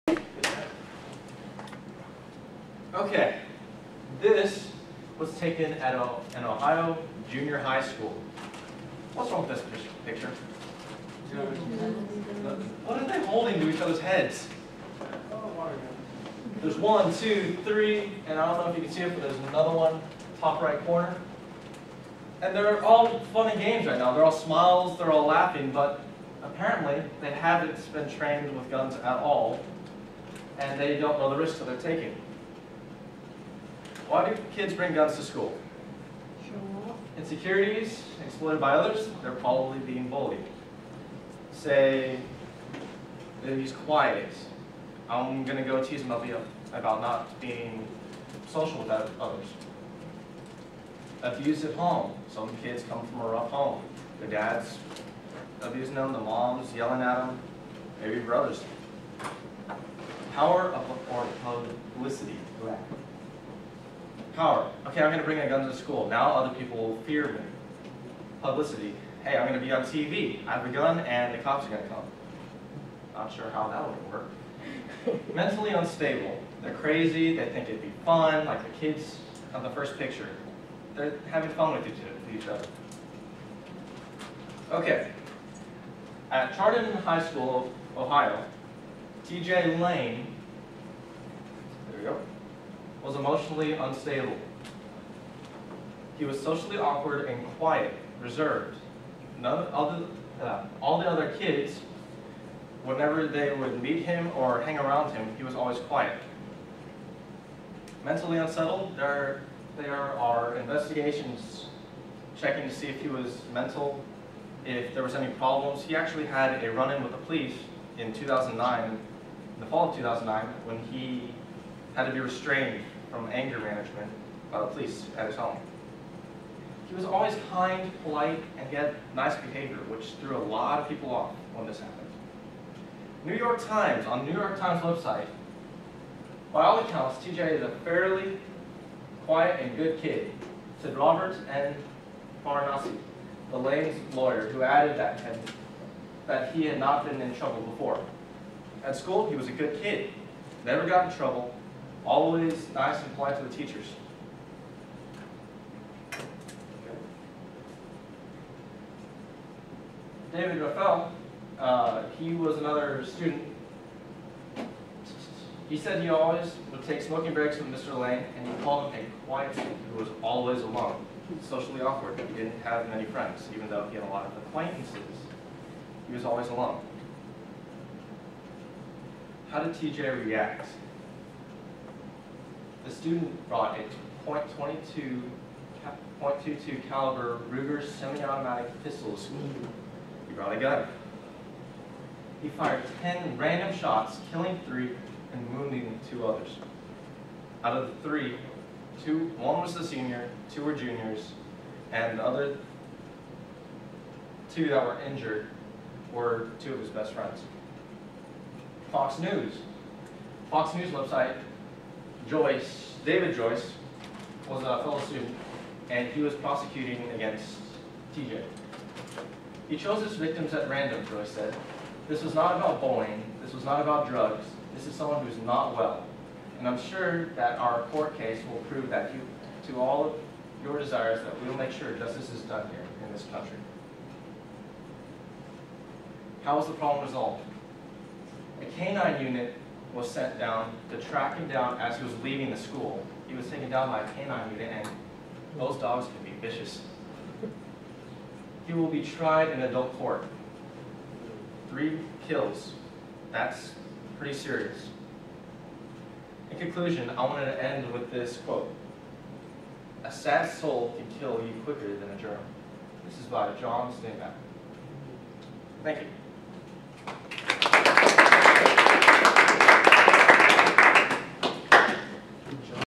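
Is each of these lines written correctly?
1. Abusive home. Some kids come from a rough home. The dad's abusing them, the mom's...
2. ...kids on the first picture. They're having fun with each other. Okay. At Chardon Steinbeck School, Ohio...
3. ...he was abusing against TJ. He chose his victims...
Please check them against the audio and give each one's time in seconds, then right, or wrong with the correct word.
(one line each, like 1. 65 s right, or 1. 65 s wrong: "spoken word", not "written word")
1. 51 s right
2. 78 s wrong: "High", not "Steinbeck"
3. 216 s wrong: "prosecuting", not "abusing".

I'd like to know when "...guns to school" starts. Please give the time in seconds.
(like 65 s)
34 s.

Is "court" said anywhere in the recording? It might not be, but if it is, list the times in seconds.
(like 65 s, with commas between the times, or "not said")
227 s, 249 s.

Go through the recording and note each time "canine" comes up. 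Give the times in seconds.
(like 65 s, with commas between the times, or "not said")
238 s, 244 s.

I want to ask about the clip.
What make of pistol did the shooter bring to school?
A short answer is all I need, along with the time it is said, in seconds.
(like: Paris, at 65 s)
Ruger, at 187 s.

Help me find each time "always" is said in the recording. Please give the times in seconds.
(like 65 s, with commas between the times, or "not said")
105 s, 127 s, 152 s, 166 s, 170 s, 176 s.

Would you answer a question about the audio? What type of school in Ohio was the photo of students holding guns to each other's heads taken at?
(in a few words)
Junior high school.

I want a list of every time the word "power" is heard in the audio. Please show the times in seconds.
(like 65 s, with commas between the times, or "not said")
60 s, 64 s.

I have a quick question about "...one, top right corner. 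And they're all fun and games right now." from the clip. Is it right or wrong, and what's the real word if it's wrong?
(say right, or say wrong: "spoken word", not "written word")
right.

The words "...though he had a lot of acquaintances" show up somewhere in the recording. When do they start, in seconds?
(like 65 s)
173 s.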